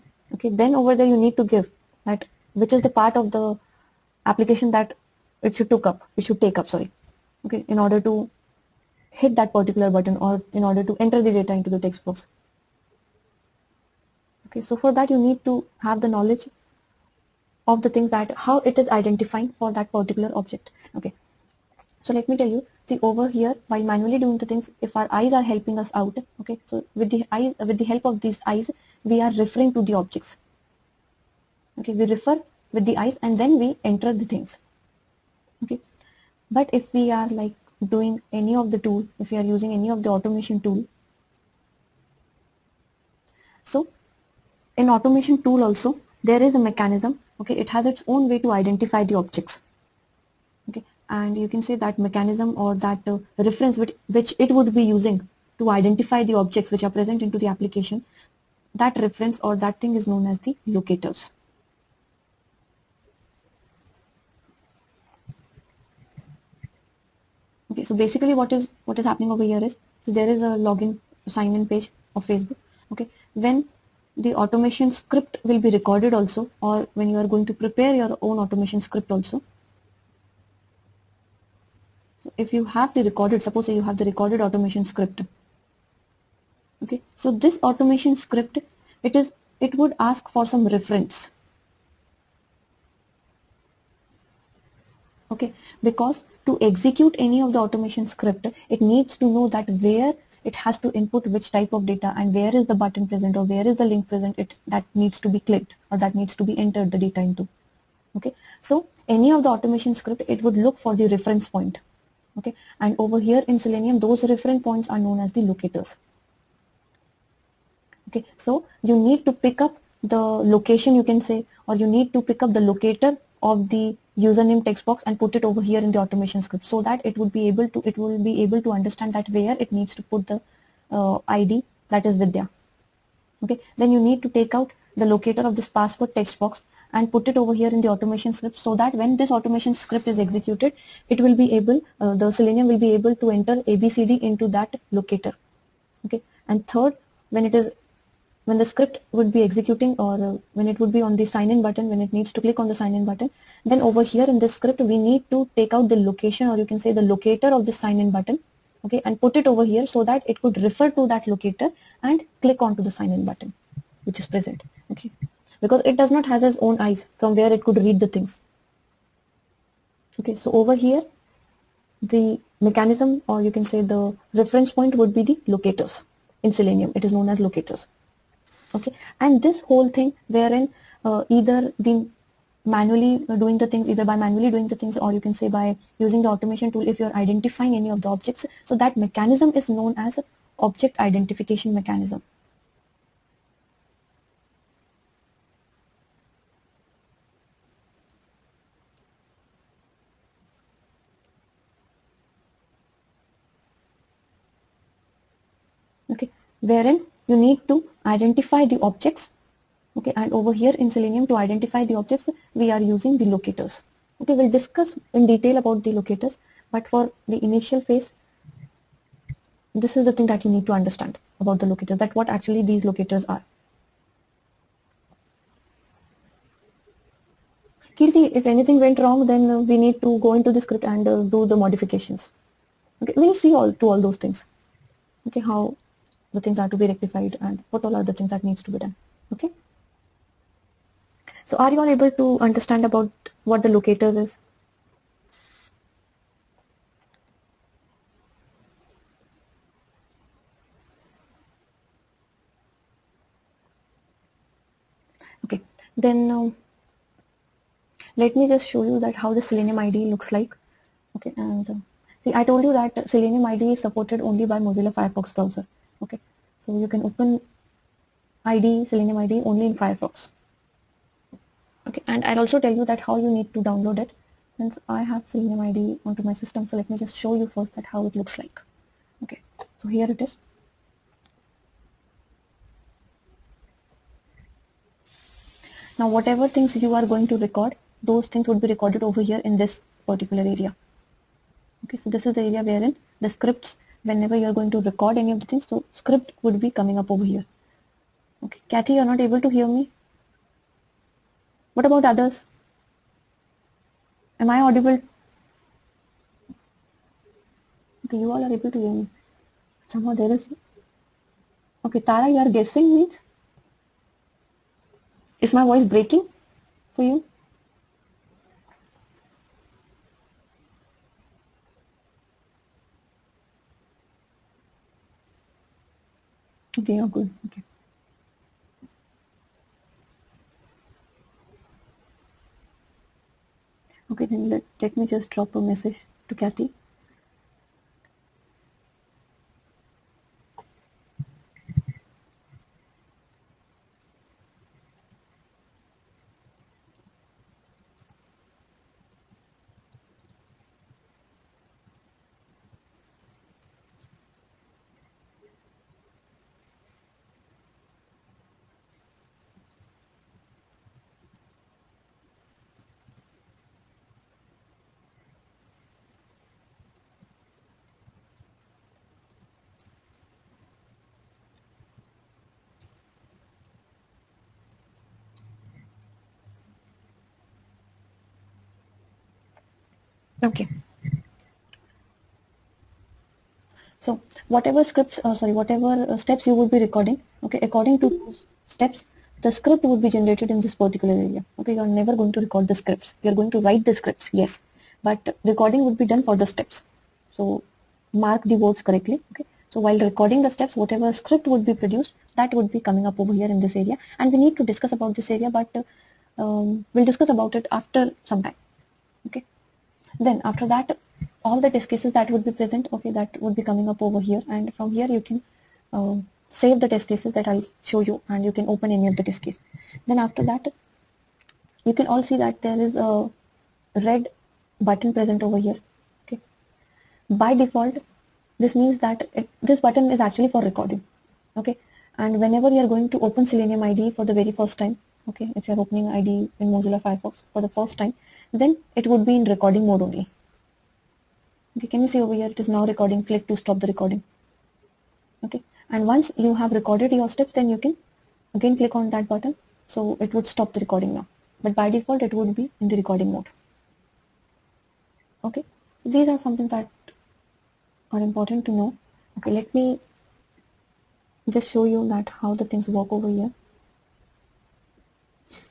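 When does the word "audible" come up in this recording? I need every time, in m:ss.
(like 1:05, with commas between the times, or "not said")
5:04.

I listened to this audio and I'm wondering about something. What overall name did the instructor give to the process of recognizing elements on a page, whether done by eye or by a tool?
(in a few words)
object identification mechanism.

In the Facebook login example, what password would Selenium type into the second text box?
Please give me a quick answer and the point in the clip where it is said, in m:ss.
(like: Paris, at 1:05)
abcd, at 2:23.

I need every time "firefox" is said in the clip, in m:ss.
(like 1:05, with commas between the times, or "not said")
4:24, 4:29, 7:17.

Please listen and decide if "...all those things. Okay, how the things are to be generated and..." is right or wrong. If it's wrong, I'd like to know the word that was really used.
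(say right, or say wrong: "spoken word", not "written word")
wrong: "rectified", not "generated".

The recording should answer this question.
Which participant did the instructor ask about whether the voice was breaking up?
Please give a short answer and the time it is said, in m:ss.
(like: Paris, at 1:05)
Tara, at 5:12.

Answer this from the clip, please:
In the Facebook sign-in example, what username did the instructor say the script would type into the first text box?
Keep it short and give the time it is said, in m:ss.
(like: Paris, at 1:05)
vidya, at 2:12.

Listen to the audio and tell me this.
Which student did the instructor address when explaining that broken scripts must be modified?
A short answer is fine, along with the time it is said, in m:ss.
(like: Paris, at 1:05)
Kirti, at 3:47.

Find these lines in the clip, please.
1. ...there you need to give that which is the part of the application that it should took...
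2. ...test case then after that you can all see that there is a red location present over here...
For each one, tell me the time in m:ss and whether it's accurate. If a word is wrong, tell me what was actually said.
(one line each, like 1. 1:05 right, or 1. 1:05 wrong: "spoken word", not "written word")
1. 0:00 right
2. 6:59 wrong: "button", not "location".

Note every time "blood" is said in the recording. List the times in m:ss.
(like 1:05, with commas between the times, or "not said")
not said.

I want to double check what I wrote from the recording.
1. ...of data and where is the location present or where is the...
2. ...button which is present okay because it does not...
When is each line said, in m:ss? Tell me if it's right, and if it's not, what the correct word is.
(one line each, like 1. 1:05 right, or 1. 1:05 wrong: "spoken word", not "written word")
1. 1:41 wrong: "button", not "location"
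2. 2:43 right.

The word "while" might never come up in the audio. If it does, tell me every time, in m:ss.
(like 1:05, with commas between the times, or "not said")
0:23, 6:39.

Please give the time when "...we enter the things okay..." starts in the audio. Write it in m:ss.
0:33.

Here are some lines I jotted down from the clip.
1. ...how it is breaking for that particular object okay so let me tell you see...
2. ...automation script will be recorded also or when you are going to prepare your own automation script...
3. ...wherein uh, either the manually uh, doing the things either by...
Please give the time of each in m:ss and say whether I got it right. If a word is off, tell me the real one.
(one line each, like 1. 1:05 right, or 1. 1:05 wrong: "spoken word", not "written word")
1. 0:18 wrong: "identifying", not "breaking"
2. 1:14 right
3. 3:00 right.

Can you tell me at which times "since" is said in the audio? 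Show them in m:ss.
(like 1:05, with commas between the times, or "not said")
4:34.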